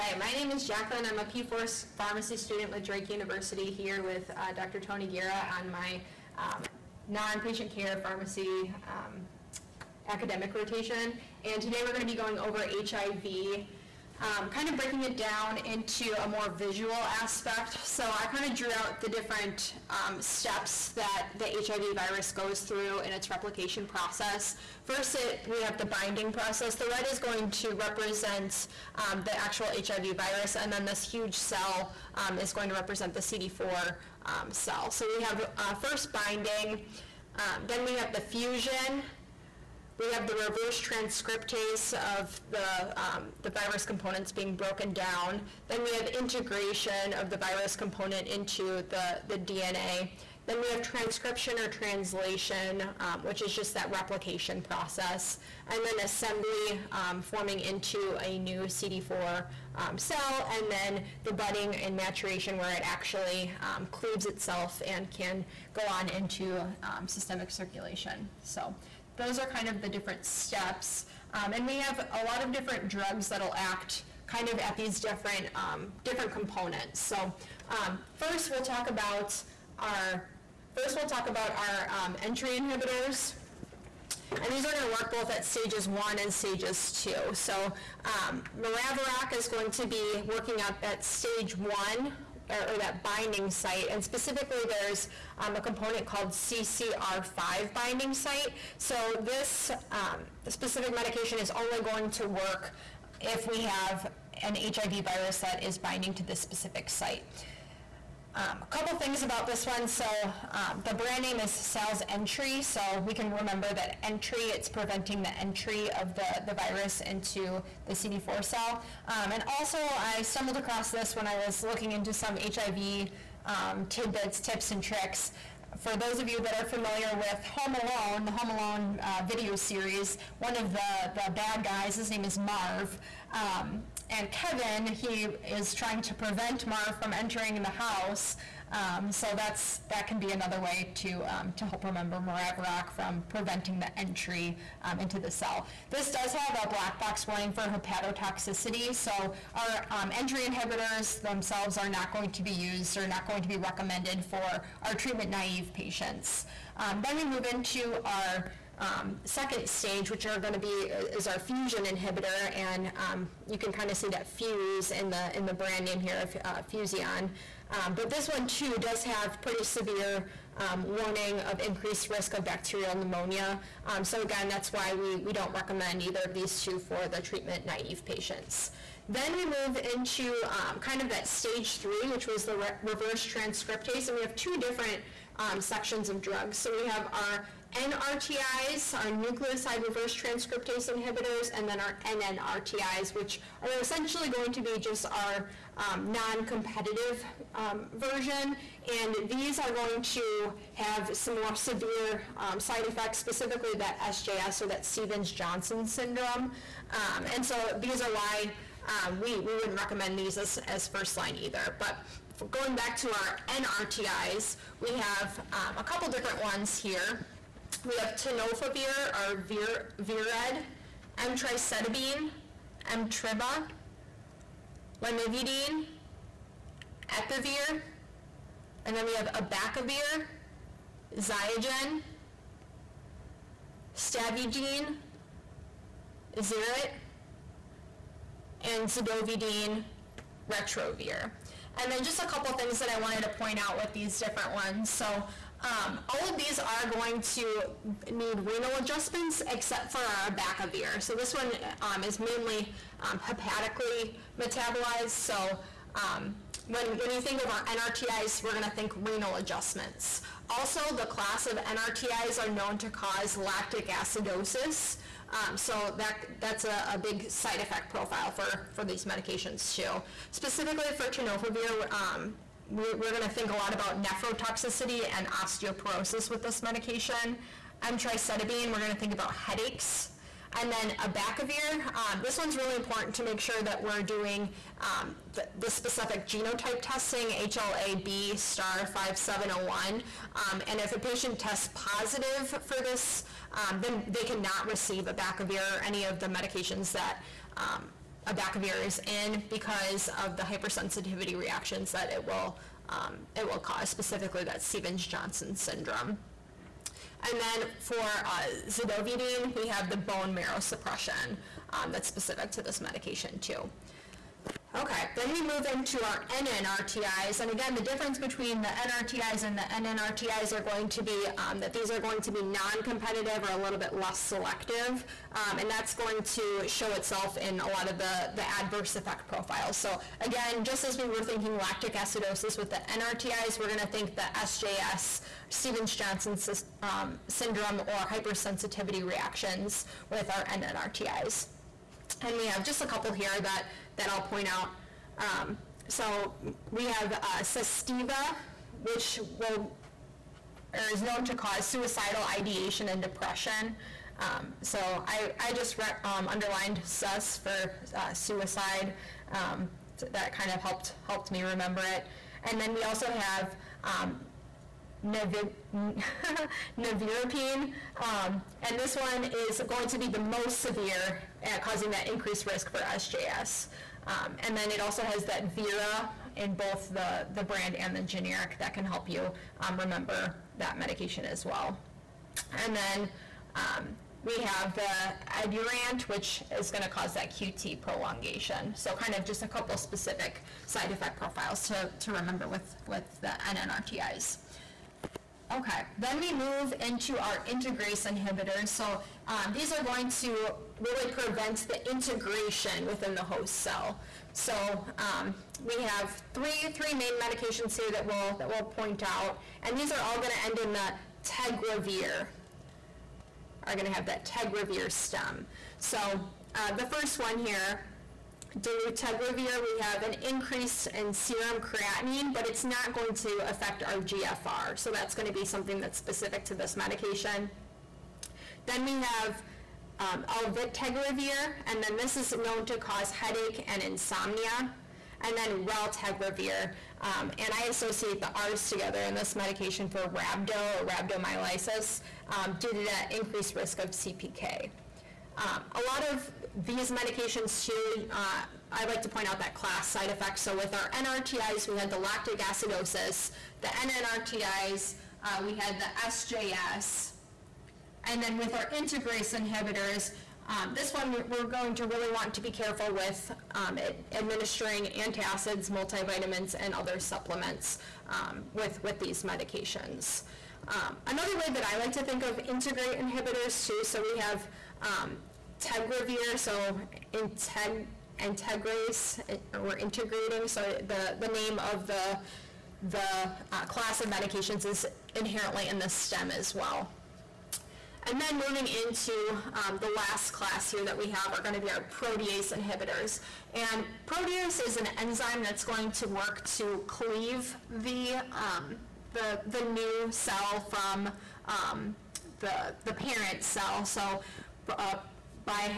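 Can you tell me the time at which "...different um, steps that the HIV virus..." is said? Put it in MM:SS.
00:19.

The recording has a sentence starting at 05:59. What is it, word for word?
Um, that kind of helped helped me remember it.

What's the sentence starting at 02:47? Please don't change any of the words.
Um, but this one too does have pretty severe um, warning of increased risk of bacterial pneumonia.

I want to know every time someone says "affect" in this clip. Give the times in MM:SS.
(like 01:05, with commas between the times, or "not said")
07:03.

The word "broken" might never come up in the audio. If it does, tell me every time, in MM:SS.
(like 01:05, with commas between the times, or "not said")
00:44.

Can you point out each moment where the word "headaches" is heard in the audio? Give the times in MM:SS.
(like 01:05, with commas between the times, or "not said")
04:39, 07:13.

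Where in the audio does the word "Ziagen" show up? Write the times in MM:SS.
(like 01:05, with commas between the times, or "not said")
03:51.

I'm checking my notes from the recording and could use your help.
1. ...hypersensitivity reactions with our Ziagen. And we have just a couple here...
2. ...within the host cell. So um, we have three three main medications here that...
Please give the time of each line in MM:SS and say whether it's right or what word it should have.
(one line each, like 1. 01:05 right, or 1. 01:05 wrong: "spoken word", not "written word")
1. 05:38 wrong: "NNRTIs", not "Ziagen"
2. 06:42 right.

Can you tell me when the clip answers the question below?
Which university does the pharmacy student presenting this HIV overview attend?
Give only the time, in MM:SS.
00:02.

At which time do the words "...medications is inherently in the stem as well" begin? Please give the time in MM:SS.
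08:04.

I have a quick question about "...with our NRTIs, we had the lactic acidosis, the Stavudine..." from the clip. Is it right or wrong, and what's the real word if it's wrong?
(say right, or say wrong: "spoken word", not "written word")
wrong: "NNRTIs", not "Stavudine".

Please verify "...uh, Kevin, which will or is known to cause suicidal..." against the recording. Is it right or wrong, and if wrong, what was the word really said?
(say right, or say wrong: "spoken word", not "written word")
wrong: "Sustiva", not "Kevin".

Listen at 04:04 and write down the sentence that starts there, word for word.
So um, all of these are going to need renal adjustments except for our abacavir.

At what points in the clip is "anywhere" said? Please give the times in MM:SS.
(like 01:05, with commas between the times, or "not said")
not said.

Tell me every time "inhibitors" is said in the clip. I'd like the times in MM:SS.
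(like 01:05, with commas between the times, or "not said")
01:22, 02:30, 02:41, 03:10, 06:38, 07:39, 07:53, 08:12.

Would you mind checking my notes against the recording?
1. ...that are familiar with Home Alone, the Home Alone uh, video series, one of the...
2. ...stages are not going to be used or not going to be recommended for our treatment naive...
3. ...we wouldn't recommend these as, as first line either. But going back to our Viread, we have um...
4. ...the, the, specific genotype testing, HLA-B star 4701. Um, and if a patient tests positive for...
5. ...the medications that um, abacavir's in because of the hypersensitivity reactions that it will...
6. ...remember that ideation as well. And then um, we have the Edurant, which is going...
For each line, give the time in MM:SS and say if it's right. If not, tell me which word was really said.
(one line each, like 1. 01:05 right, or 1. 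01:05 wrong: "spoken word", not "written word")
1. 02:06 right
2. 02:31 wrong: "themselves", not "stages"
3. 03:29 wrong: "NRTIs", not "Viread"
4. 04:45 wrong: "5701", not "4701"
5. 04:56 right
6. 06:19 wrong: "medication", not "ideation".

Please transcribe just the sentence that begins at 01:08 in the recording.
So those are kind of the different steps.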